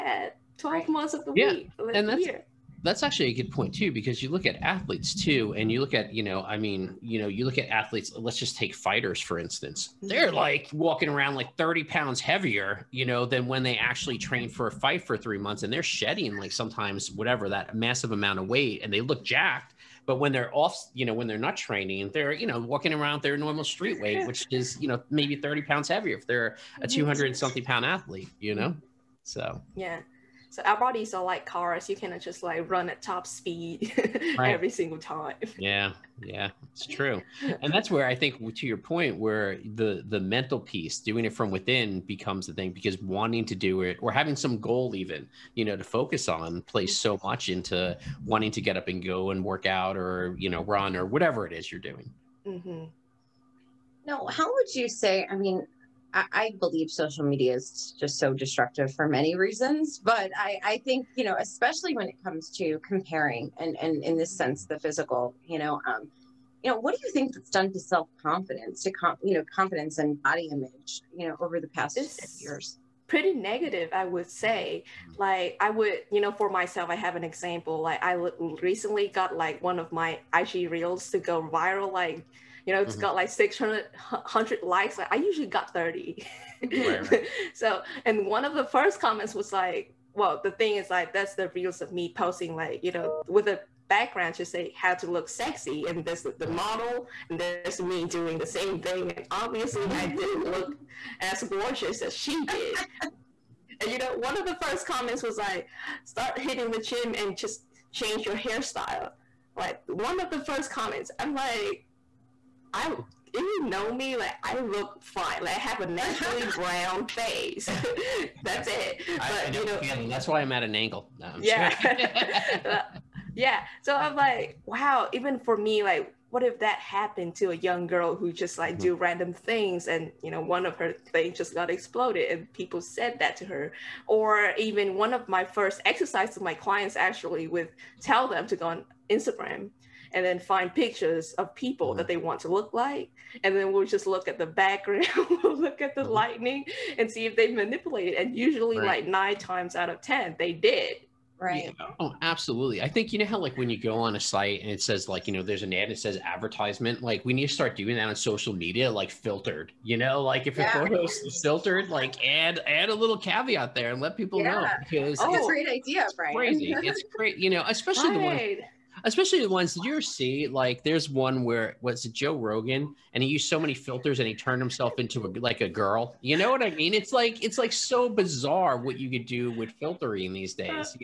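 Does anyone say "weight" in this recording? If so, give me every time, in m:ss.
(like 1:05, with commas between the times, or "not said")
0:18, 0:23.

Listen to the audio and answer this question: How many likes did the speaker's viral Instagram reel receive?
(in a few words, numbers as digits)
600.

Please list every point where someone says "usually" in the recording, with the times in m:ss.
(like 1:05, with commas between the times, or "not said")
1:25, 2:28.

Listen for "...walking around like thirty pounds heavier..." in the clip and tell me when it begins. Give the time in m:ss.
0:10.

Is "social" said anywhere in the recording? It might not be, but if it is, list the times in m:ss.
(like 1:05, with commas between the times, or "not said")
0:56, 2:38.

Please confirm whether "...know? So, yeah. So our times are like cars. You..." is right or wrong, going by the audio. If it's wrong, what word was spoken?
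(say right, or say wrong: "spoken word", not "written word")
wrong: "bodies", not "times".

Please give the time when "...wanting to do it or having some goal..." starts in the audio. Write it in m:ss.
0:42.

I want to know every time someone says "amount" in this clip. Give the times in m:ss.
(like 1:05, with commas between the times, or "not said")
0:18.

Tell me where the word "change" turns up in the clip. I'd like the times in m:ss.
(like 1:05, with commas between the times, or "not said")
1:47.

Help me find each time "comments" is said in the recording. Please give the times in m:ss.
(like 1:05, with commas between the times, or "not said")
1:28, 1:44, 1:50.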